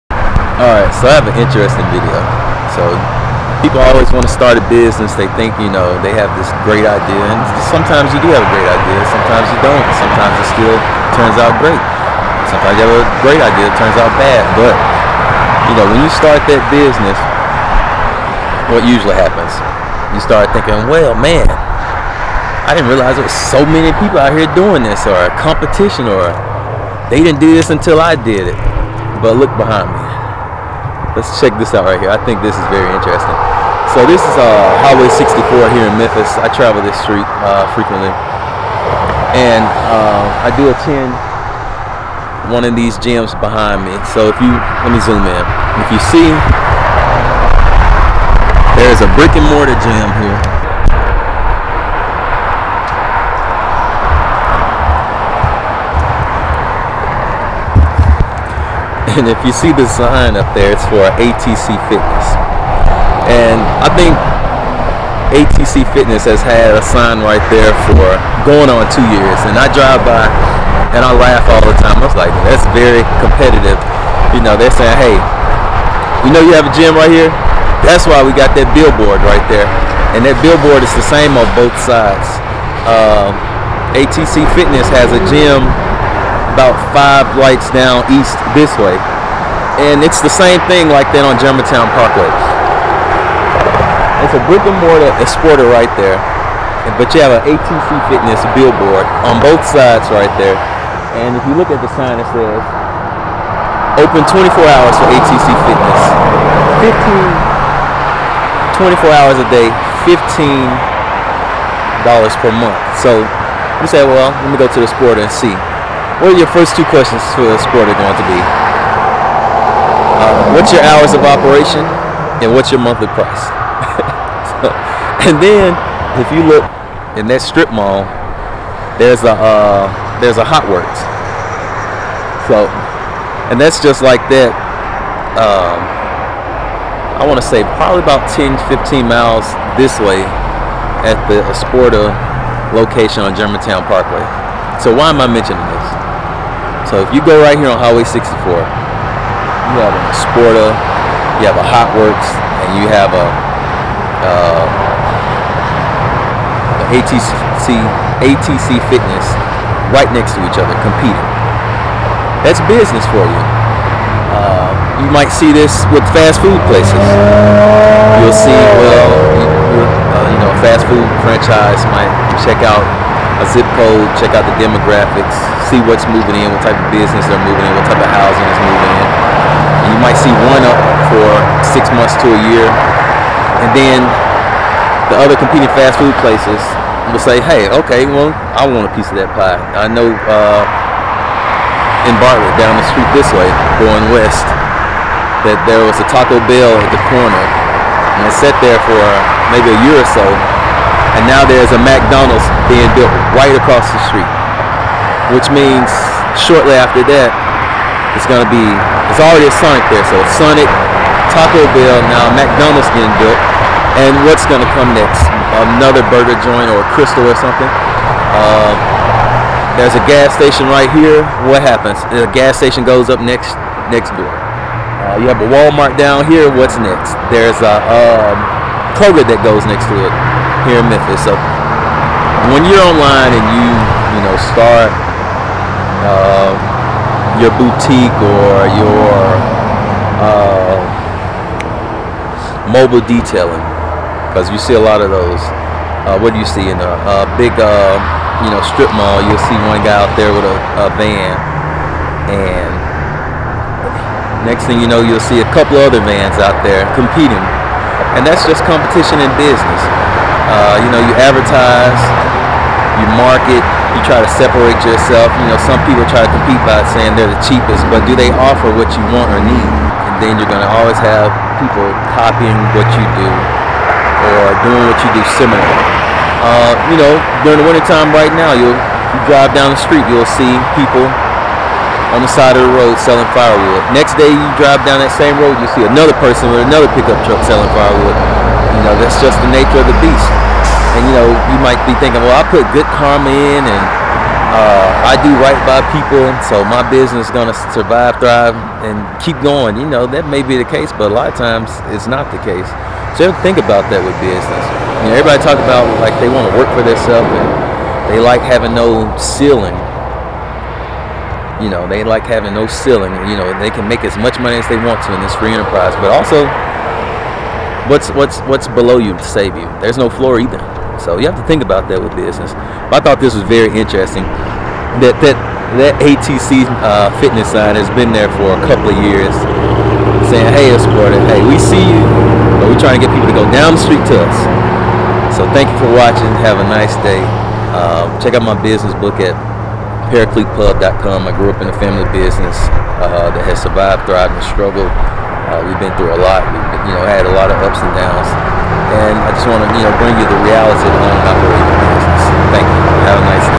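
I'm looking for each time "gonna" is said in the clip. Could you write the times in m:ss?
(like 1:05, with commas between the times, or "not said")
3:28, 3:34, 4:57.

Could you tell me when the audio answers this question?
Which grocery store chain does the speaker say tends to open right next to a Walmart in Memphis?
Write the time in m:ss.
3:48.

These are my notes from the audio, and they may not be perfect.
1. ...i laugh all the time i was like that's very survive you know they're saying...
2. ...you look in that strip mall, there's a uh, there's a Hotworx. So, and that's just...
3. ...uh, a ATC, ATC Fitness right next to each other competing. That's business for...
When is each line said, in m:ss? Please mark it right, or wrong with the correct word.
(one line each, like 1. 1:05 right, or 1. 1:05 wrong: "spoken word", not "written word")
1. 1:11 wrong: "competitive", not "survive"
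2. 2:06 right
3. 2:34 right.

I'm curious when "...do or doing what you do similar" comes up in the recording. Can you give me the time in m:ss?
4:33.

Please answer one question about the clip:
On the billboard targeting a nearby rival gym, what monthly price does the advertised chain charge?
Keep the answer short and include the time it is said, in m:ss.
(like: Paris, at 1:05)
$15 per month, at 1:50.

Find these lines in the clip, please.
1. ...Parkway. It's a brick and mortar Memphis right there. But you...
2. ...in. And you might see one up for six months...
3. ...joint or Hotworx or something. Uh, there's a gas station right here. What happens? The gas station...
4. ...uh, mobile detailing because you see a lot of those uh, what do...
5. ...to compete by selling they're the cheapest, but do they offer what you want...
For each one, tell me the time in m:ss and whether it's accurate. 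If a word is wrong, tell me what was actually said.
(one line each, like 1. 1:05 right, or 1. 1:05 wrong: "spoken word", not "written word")
1. 1:31 wrong: "Esporta", not "Memphis"
2. 2:58 right
3. 3:36 wrong: "Krystal", not "Hotworx"
4. 4:00 right
5. 4:26 wrong: "saying", not "selling".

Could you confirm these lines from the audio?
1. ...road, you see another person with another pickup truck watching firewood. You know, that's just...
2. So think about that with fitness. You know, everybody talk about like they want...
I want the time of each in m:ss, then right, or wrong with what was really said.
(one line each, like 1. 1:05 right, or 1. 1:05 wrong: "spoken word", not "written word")
1. 4:45 wrong: "selling", not "watching"
2. 5:03 wrong: "business", not "fitness".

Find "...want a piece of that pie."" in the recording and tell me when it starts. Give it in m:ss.
3:08.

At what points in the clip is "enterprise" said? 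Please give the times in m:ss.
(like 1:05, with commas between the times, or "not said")
5:15.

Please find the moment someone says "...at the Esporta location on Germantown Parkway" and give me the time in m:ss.
2:21.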